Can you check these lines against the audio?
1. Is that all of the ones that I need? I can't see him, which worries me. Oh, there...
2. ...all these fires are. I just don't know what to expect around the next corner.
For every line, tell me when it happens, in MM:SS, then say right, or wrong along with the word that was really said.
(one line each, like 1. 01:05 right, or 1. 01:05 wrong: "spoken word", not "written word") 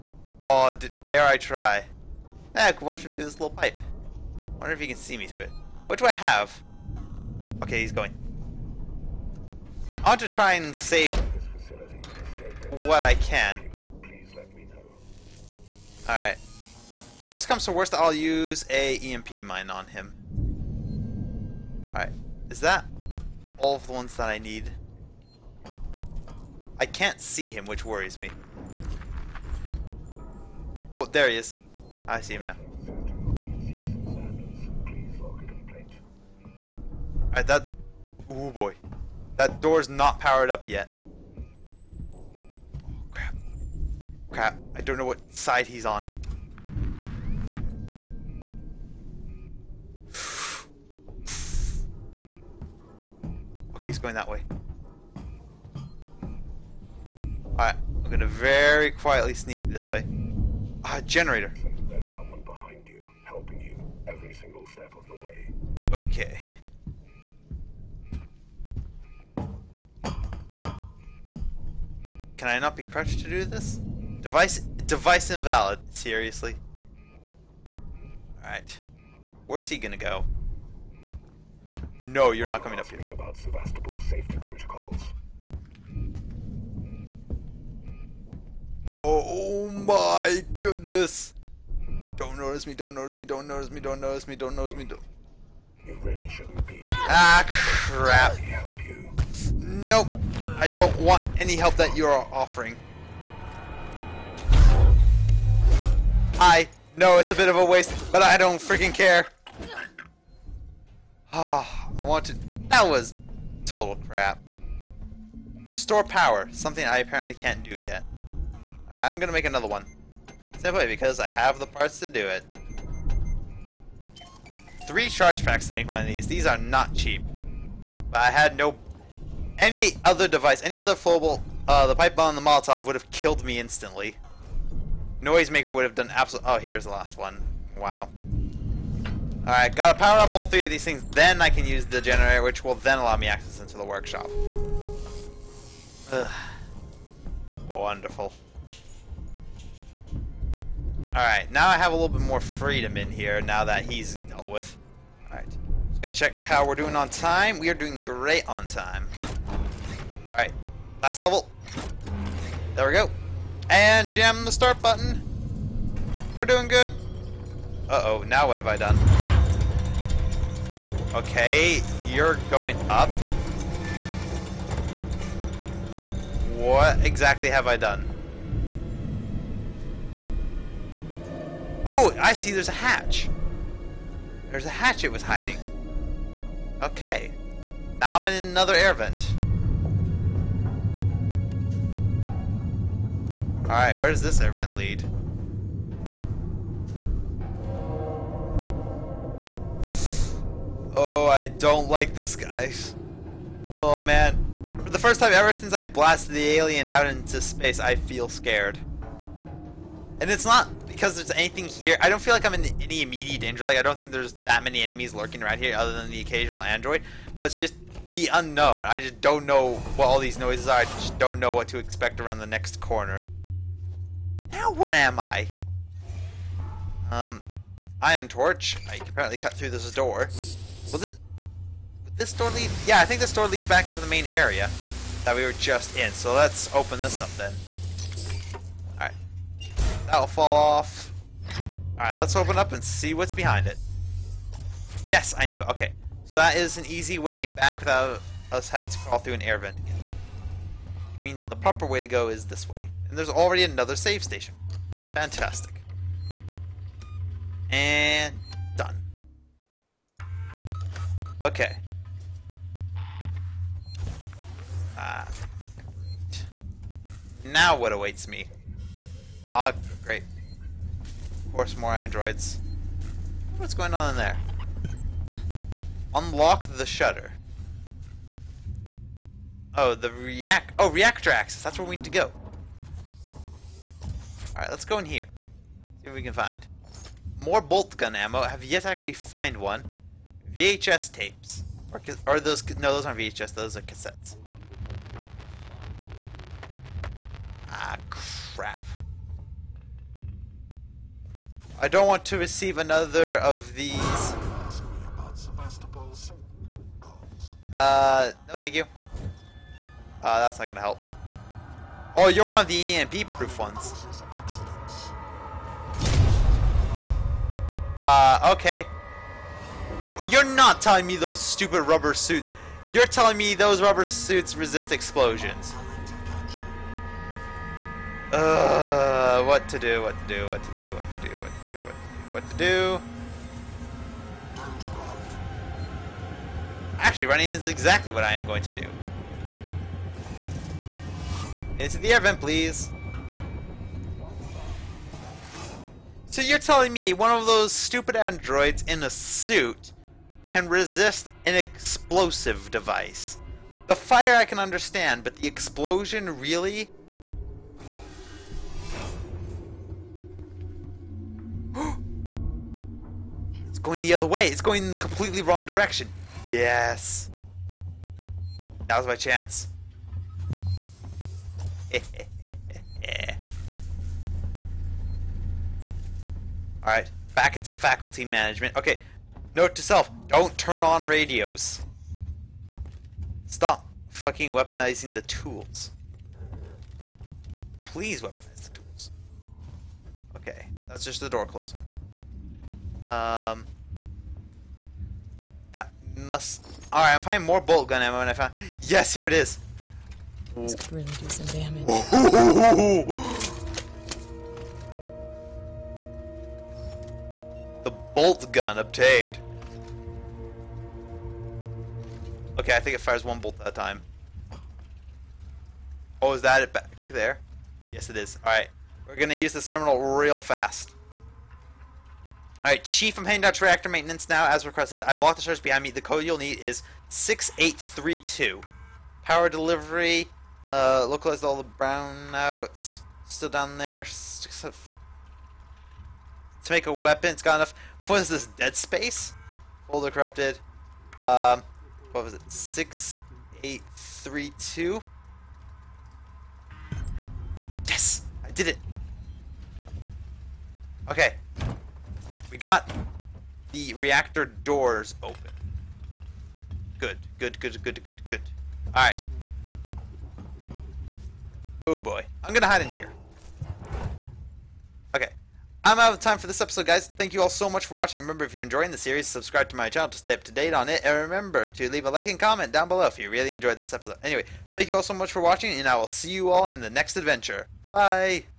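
1. 00:22 right
2. 03:40 wrong: "noises", not "fires".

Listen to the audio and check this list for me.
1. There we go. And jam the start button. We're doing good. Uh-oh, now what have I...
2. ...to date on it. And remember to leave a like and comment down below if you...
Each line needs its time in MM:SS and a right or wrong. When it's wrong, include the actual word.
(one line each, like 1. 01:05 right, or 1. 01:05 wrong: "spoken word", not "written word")
1. 02:42 right
2. 07:50 right.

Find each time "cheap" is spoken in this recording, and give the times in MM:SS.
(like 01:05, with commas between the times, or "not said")
02:06.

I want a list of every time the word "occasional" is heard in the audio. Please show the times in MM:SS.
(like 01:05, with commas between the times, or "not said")
03:36.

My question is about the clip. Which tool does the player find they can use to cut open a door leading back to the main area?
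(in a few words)
Ion torch.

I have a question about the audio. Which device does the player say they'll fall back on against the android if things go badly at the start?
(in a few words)
EMP mine.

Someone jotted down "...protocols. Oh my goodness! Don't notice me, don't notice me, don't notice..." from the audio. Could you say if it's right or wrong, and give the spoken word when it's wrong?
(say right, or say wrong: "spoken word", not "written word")
right.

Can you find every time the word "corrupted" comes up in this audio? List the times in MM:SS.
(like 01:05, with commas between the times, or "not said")
07:20.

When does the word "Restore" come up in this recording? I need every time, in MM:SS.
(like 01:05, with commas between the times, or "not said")
01:55.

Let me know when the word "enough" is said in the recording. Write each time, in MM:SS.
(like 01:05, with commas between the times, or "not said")
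07:17.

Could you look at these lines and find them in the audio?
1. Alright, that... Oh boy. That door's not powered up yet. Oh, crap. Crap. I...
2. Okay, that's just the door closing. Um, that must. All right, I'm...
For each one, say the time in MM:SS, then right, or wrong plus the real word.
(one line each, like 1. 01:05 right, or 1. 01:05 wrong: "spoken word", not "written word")
1. 00:37 right
2. 06:30 right.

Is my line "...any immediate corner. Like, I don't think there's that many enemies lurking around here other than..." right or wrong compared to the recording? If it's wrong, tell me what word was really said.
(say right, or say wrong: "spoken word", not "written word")
wrong: "danger", not "corner".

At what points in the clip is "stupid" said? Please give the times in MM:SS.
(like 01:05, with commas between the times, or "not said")
05:21, 05:47.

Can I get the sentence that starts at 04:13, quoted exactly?
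And there's already another save station.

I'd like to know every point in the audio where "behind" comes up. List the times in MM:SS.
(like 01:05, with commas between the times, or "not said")
04:03, 07:05.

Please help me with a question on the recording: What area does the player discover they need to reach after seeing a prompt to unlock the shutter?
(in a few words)
Reactor access.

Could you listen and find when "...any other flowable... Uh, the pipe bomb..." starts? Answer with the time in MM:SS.
02:10.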